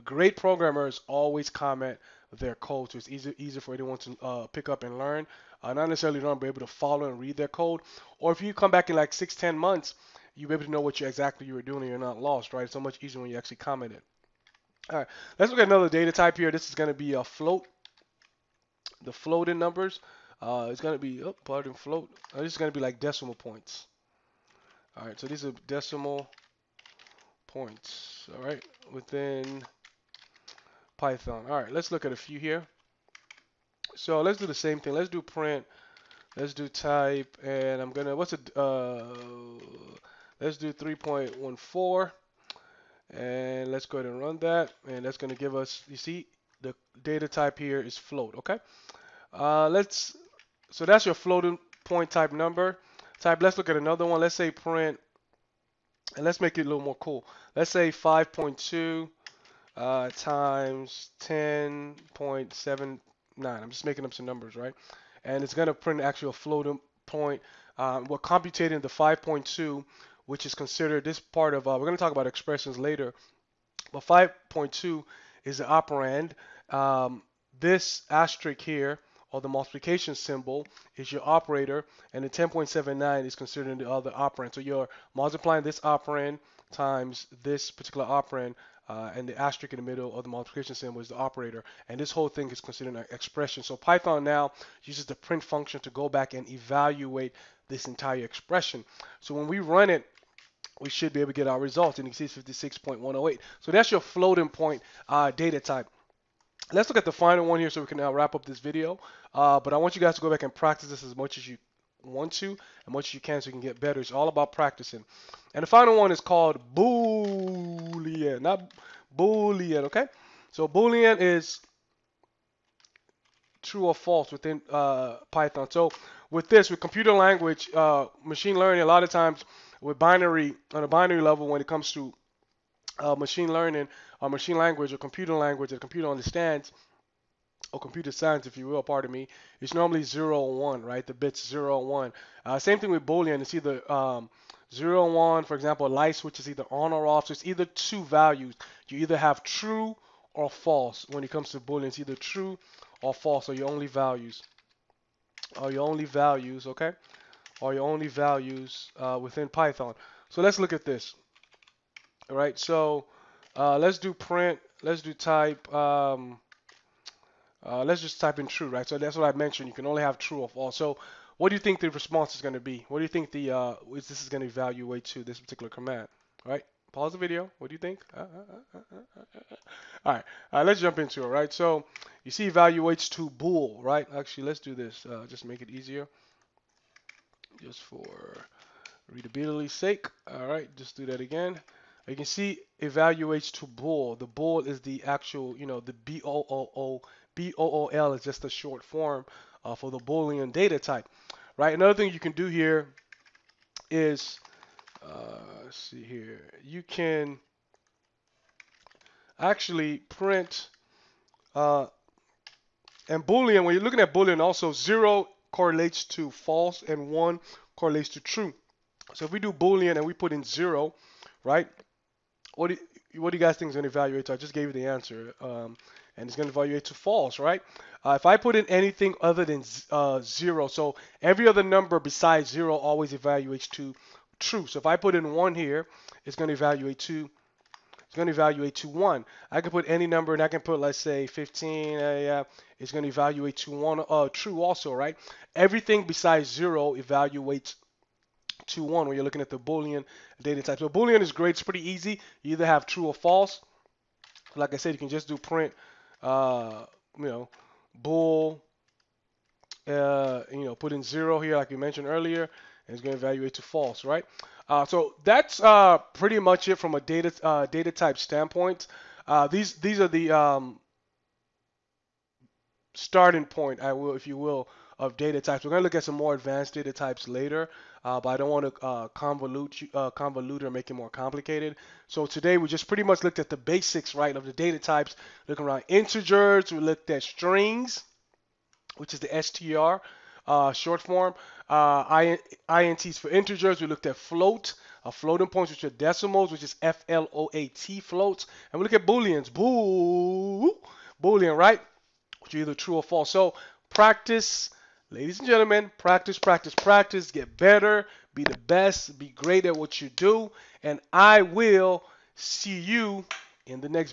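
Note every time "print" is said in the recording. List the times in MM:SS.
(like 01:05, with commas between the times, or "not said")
00:35, 00:54, 01:05, 01:35, 02:44, 03:29, 04:15.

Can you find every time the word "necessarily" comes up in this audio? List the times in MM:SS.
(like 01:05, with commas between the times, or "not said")
00:05.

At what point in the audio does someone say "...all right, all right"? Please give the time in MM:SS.
03:00.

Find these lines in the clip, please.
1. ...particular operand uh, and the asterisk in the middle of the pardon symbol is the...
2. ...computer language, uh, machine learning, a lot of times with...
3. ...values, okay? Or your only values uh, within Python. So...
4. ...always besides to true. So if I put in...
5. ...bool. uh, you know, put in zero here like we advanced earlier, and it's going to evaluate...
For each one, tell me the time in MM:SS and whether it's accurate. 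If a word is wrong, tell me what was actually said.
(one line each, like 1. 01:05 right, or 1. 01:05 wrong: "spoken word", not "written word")
1. 01:27 wrong: "multiplication", not "pardon"
2. 02:06 right
3. 02:36 right
4. 03:52 wrong: "evaluates", not "besides"
5. 04:17 wrong: "mentioned", not "advanced".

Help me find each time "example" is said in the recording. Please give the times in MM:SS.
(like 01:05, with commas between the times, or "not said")
02:25.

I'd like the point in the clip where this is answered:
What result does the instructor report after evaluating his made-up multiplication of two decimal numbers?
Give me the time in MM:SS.
01:42.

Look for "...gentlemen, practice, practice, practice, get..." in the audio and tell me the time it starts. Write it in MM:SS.
05:05.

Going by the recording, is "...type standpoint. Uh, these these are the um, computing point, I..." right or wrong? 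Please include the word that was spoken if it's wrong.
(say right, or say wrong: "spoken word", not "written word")
wrong: "starting", not "computing".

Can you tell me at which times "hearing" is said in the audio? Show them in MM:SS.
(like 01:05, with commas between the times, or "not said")
not said.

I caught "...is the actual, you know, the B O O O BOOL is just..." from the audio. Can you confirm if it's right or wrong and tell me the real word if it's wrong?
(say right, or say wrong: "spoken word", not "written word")
right.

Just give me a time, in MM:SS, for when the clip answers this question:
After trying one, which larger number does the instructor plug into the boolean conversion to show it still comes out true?
04:01.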